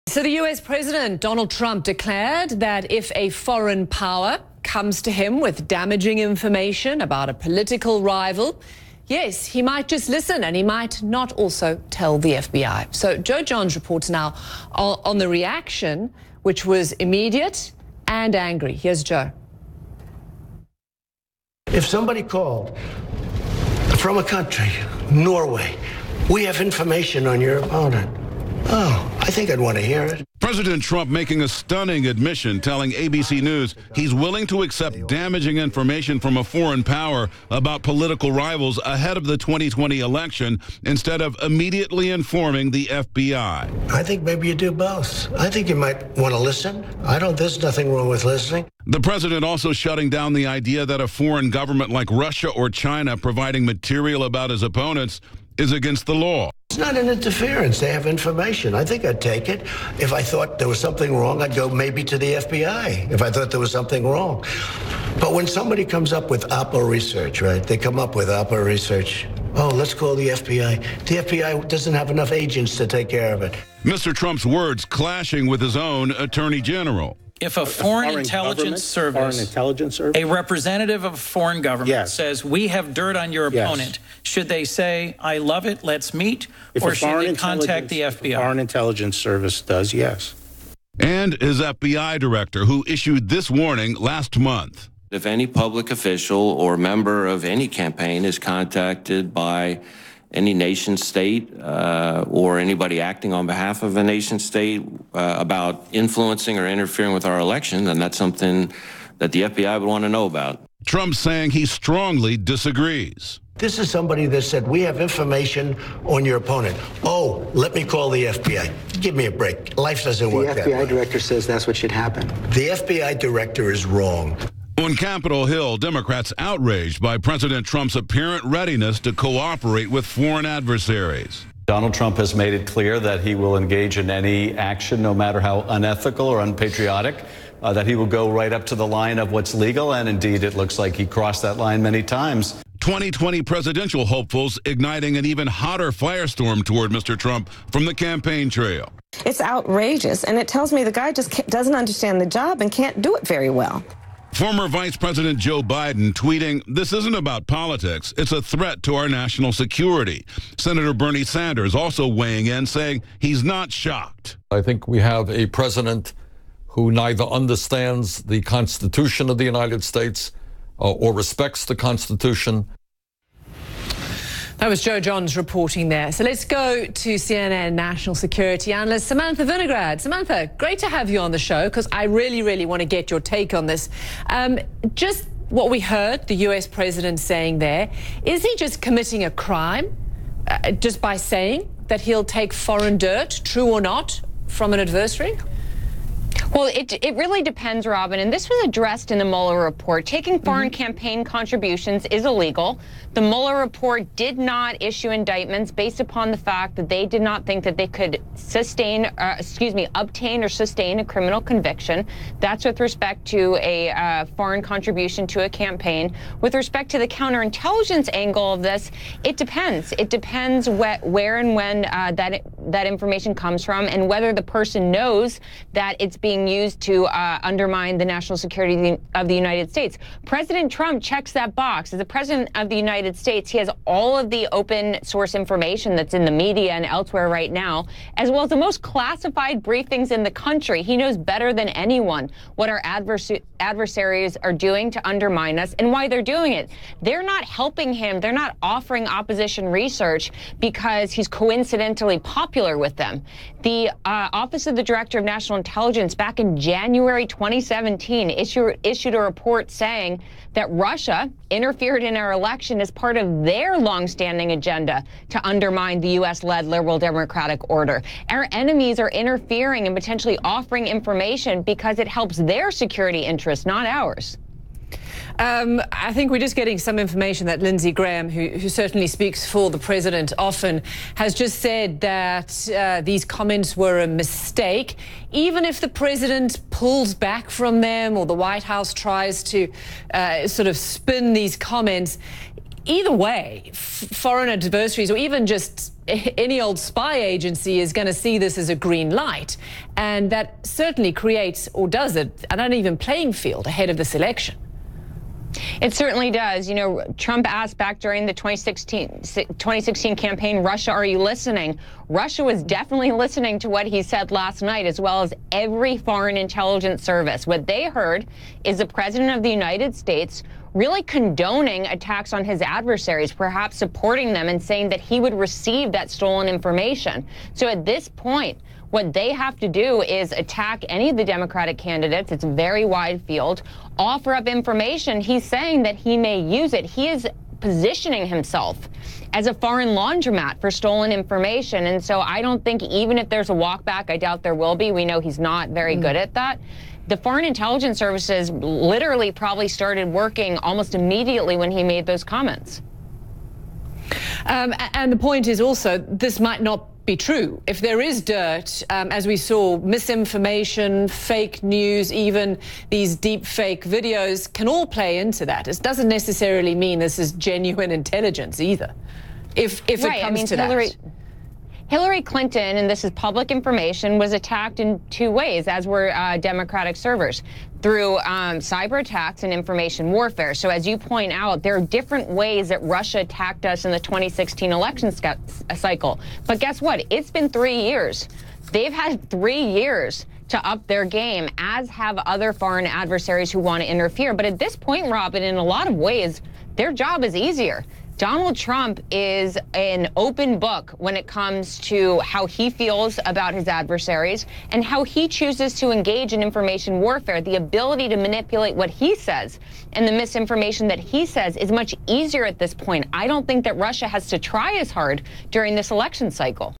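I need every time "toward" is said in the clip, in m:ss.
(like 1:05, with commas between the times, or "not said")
2:26.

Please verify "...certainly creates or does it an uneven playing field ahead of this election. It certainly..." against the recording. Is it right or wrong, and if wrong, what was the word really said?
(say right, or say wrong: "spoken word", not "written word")
right.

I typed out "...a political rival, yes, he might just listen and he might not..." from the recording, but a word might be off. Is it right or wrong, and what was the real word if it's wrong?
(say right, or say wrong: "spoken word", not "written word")
right.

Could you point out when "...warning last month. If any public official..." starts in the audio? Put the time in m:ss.
1:33.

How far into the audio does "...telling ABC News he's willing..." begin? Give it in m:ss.
0:32.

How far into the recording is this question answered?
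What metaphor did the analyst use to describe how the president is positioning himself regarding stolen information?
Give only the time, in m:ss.
5:39.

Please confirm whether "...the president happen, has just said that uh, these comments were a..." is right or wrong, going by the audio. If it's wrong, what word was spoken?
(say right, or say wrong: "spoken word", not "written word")
wrong: "often", not "happen".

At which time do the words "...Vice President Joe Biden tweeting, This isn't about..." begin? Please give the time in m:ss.
2:34.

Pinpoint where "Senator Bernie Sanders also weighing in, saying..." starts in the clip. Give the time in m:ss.
2:40.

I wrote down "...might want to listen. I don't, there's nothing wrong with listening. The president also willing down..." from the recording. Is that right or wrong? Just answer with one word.
wrong.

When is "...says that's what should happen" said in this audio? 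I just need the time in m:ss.
2:01.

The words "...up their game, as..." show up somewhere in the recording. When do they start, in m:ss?
6:30.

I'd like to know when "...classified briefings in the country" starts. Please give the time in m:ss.
3:58.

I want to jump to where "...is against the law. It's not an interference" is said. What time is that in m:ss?
0:55.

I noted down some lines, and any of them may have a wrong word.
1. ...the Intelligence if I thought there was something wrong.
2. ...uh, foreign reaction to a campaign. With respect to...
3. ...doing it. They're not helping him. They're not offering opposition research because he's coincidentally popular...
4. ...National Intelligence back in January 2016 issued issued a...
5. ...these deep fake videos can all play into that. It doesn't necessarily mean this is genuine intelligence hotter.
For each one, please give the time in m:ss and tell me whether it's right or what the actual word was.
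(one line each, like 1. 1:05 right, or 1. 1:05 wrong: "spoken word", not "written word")
1. 1:02 wrong: "FBI", not "Intelligence"
2. 3:33 wrong: "contribution", not "reaction"
3. 4:06 right
4. 4:15 wrong: "2017", not "2016"
5. 6:02 wrong: "either", not "hotter".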